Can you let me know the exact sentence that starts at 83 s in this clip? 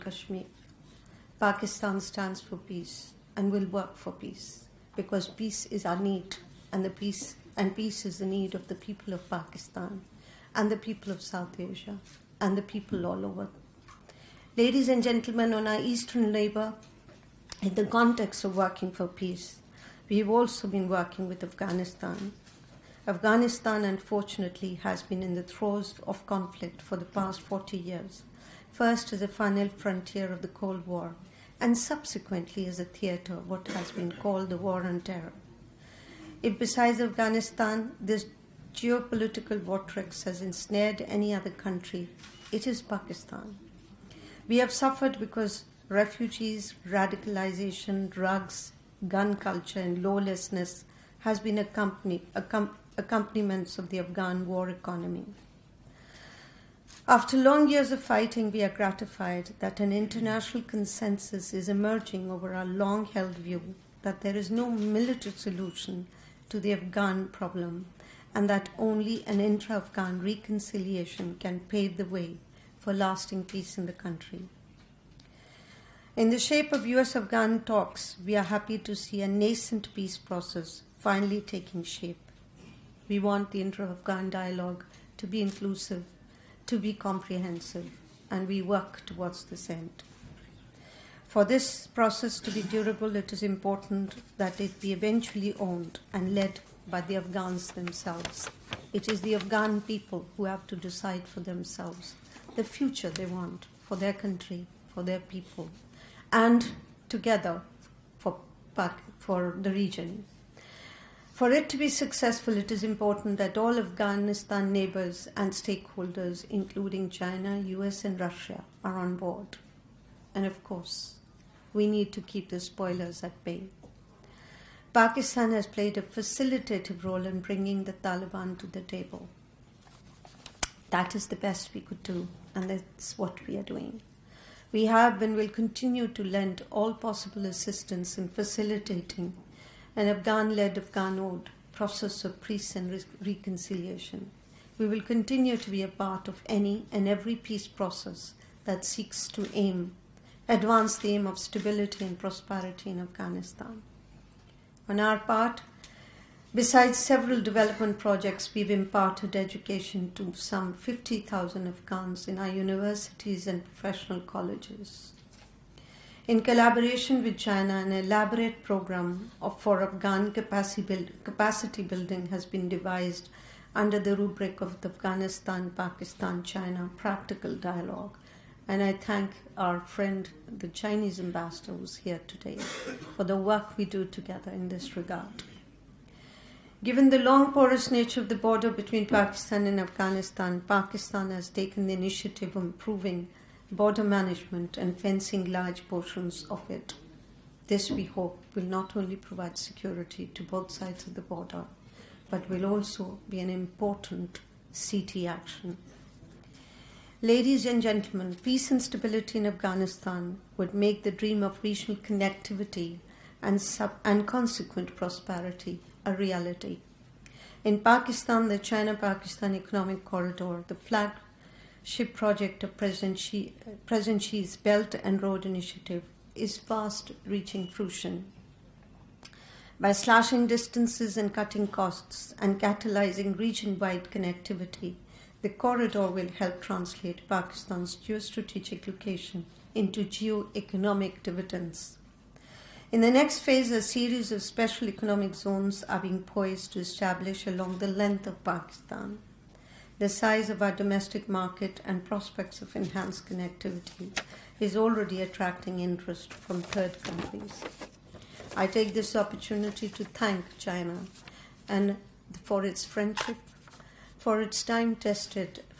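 We want the intra Afghan dialogue to be inclusive, to be comprehensive, and we work towards this end.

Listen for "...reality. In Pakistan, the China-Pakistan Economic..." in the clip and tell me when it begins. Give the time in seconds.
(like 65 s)
216 s.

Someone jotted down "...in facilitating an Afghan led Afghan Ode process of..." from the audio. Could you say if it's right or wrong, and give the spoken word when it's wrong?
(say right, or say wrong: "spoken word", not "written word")
right.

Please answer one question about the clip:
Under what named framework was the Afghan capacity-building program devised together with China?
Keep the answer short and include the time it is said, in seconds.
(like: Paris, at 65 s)
Afghanistan Pakistan China Practical Dialogue, at 174 s.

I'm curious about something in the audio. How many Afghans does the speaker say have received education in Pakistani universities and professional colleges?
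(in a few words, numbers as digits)
50,000.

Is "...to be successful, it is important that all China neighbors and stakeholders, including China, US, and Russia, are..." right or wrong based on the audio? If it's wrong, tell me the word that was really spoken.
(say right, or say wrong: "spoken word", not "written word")
wrong: "Afghanistan", not "China".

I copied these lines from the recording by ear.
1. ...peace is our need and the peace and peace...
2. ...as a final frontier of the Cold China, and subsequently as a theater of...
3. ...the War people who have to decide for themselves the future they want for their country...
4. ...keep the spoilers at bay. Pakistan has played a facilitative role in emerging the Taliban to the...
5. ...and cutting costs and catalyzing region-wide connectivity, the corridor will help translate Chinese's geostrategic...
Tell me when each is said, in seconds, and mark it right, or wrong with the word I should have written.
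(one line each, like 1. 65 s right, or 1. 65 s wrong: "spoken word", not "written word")
1. 5 s right
2. 29 s wrong: "War", not "China"
3. 99 s wrong: "Afghan", not "War"
4. 122 s wrong: "bringing", not "emerging"
5. 231 s wrong: "Pakistan", not "Chinese".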